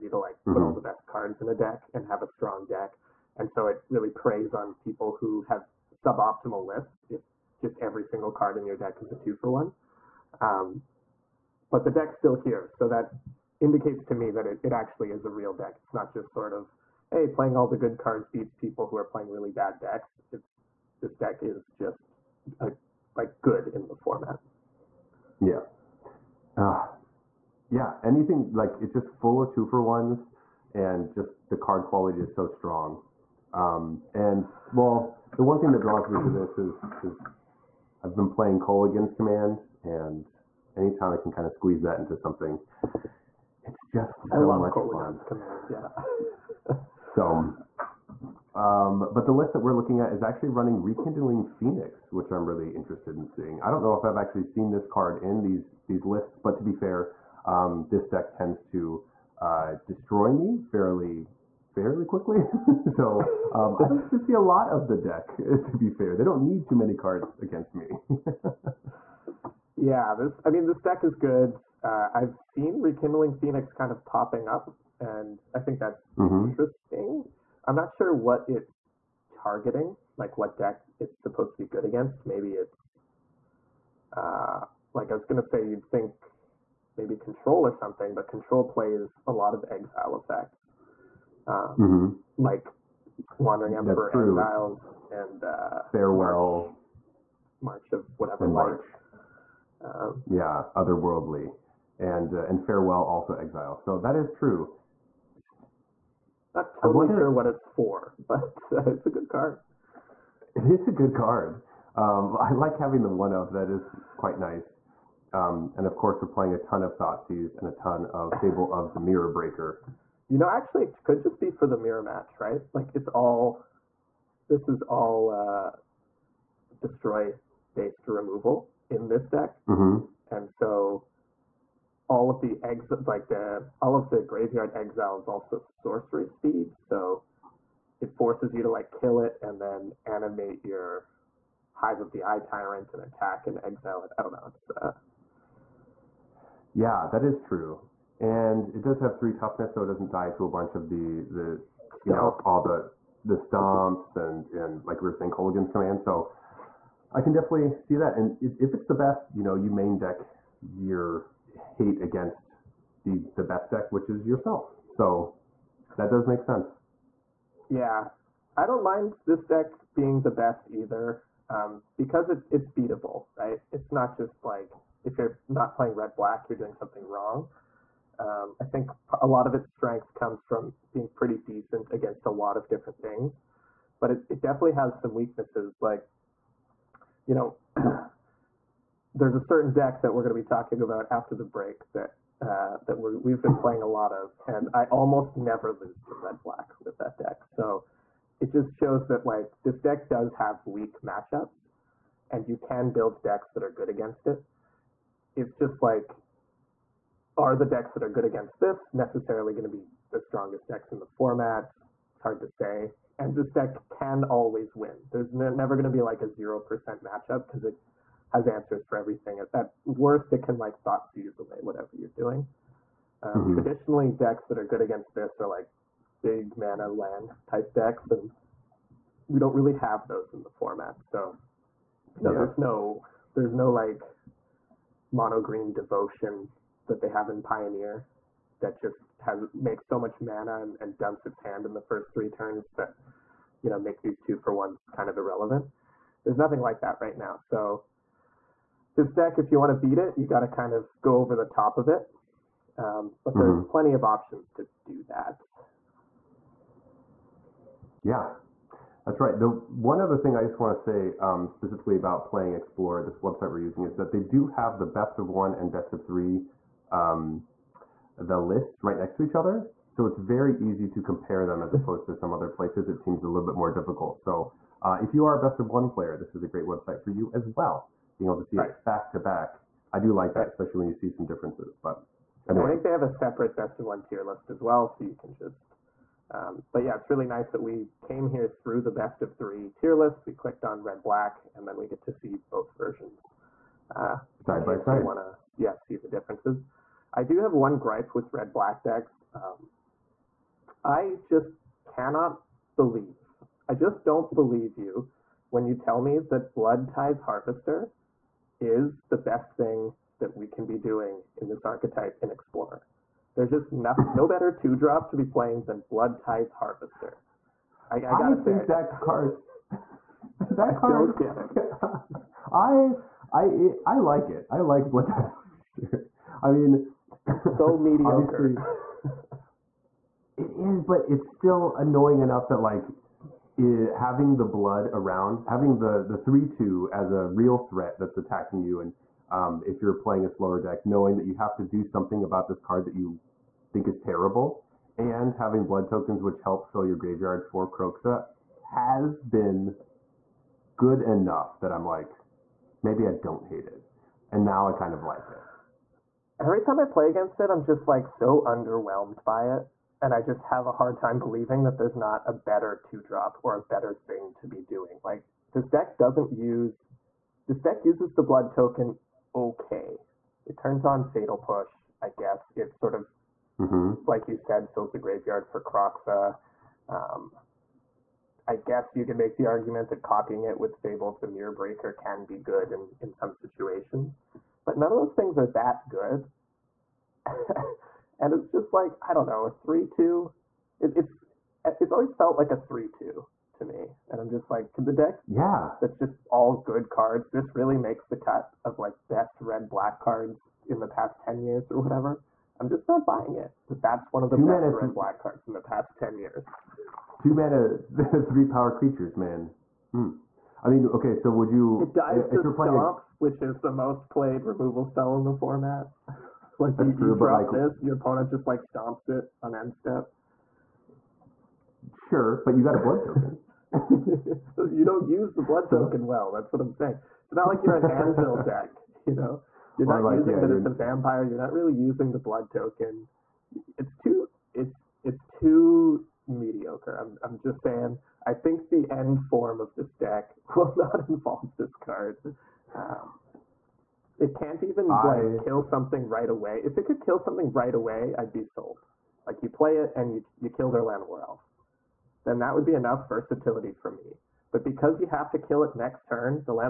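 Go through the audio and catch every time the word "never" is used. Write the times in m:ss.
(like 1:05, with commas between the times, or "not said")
3:15, 3:35.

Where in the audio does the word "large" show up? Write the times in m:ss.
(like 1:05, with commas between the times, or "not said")
not said.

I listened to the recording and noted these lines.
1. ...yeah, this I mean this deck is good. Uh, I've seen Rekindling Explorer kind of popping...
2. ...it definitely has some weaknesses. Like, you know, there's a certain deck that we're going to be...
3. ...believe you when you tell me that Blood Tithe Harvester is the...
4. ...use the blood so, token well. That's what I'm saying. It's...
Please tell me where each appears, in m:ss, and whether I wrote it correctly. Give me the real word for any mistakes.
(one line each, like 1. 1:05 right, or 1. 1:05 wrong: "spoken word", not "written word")
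1. 1:09 wrong: "Phoenix", not "Explorer"
2. 3:04 right
3. 5:04 right
4. 7:05 right.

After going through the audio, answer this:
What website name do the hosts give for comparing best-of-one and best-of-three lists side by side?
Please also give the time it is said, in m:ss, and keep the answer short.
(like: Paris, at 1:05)
Explore, at 4:22.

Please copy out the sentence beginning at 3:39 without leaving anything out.
At, at worst, it can like thought seize away whatever you're doing.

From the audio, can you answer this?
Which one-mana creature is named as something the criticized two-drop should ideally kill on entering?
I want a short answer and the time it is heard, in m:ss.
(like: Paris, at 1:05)
Llanowar Elf, at 7:30.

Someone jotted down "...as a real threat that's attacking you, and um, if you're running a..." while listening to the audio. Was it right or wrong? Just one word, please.
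wrong.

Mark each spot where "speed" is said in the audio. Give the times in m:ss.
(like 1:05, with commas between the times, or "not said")
2:16.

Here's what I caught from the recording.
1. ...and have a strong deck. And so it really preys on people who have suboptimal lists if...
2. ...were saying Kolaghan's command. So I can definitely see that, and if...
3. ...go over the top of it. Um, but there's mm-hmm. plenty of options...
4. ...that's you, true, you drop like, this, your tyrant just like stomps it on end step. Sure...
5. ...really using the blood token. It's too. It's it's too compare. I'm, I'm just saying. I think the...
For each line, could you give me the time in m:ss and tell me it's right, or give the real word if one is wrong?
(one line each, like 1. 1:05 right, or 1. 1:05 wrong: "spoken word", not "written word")
1. 0:01 right
2. 2:35 right
3. 4:11 right
4. 6:56 wrong: "opponent", not "tyrant"
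5. 7:11 wrong: "mediocre", not "compare".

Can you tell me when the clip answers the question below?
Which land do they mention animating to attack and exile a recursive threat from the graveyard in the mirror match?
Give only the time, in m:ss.
2:21.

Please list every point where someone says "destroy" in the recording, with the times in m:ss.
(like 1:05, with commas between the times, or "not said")
0:59, 2:06.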